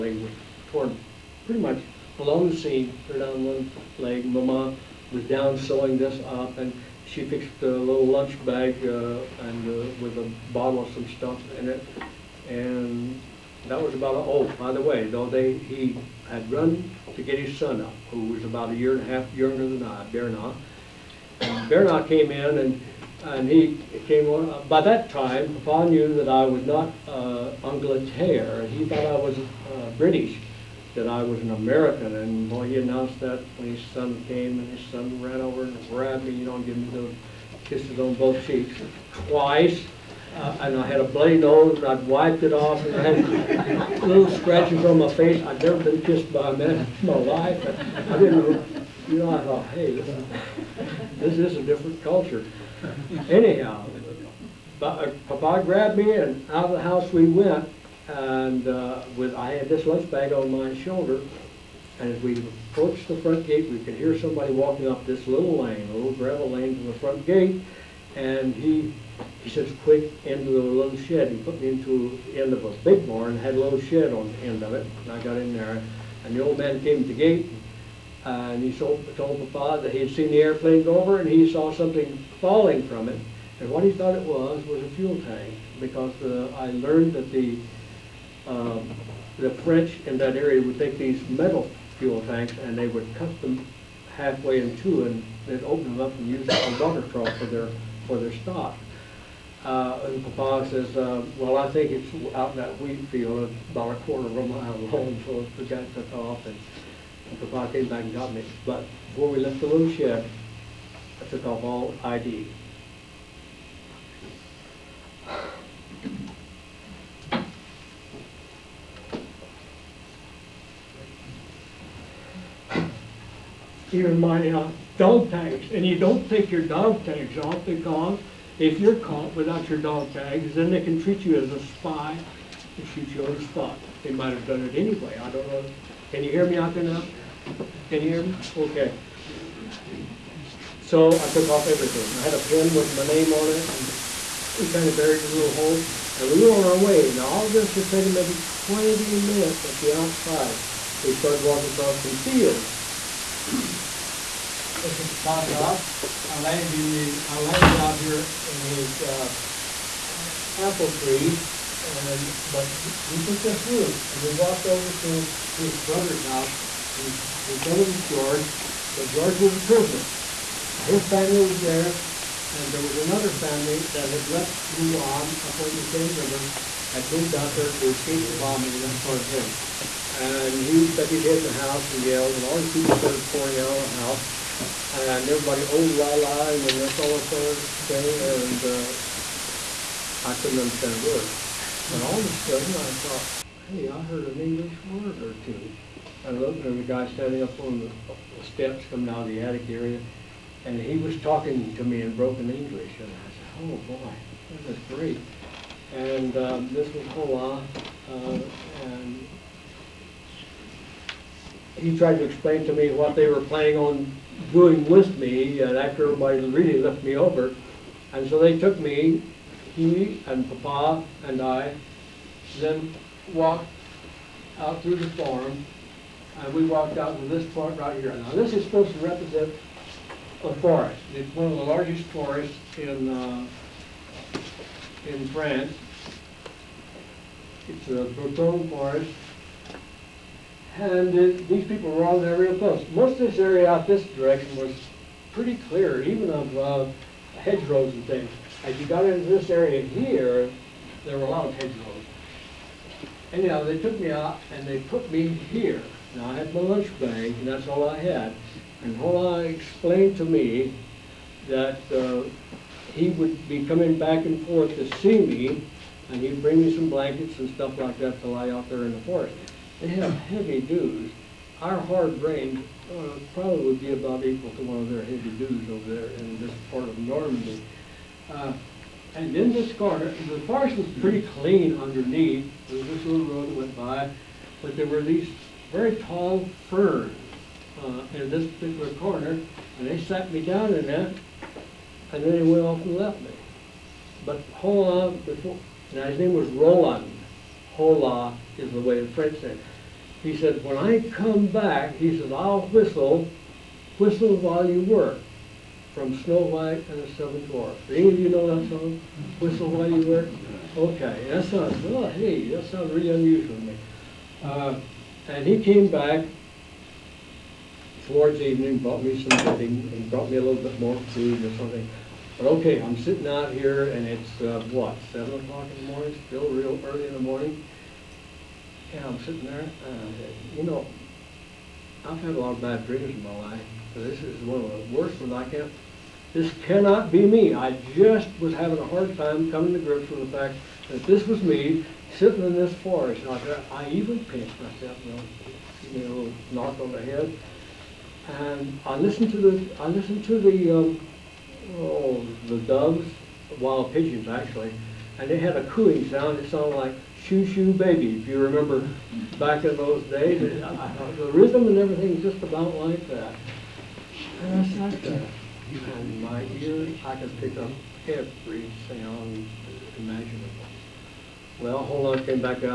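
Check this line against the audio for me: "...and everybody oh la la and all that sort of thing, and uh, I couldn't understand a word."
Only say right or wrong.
right.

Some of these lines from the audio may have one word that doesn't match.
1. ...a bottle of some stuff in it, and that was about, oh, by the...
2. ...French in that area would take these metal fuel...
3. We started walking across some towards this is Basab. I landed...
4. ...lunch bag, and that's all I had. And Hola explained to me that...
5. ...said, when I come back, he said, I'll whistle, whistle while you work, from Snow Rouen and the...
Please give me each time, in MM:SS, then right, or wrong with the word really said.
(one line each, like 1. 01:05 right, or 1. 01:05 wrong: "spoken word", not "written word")
1. 00:10 right
2. 01:29 right
3. 02:31 wrong: "fields", not "towards"
4. 04:16 right
5. 05:00 wrong: "White", not "Rouen".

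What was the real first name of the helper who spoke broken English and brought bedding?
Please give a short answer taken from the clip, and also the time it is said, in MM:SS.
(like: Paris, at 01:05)
Roland, at 04:56.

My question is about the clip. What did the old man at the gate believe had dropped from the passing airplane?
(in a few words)
A fuel tank.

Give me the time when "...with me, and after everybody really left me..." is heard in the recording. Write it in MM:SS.
03:34.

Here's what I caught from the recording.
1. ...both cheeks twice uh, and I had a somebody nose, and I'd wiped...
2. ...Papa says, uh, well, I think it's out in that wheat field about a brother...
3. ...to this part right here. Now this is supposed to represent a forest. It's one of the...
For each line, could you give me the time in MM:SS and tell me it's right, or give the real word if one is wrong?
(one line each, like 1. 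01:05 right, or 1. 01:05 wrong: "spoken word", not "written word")
1. 00:38 wrong: "bloody", not "somebody"
2. 01:40 wrong: "quarter", not "brother"
3. 03:47 right.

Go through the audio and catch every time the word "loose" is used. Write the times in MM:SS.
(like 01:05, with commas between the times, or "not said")
01:49.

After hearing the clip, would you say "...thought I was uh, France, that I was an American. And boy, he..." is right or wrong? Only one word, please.
wrong.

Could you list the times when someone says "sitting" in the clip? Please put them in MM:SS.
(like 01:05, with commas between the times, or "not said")
05:22, 05:29, 05:42.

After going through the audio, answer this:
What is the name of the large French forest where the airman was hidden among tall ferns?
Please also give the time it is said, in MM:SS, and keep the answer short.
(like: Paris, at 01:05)
Brotonne, at 03:58.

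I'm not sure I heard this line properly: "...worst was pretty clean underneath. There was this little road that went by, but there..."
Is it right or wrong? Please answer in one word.
wrong.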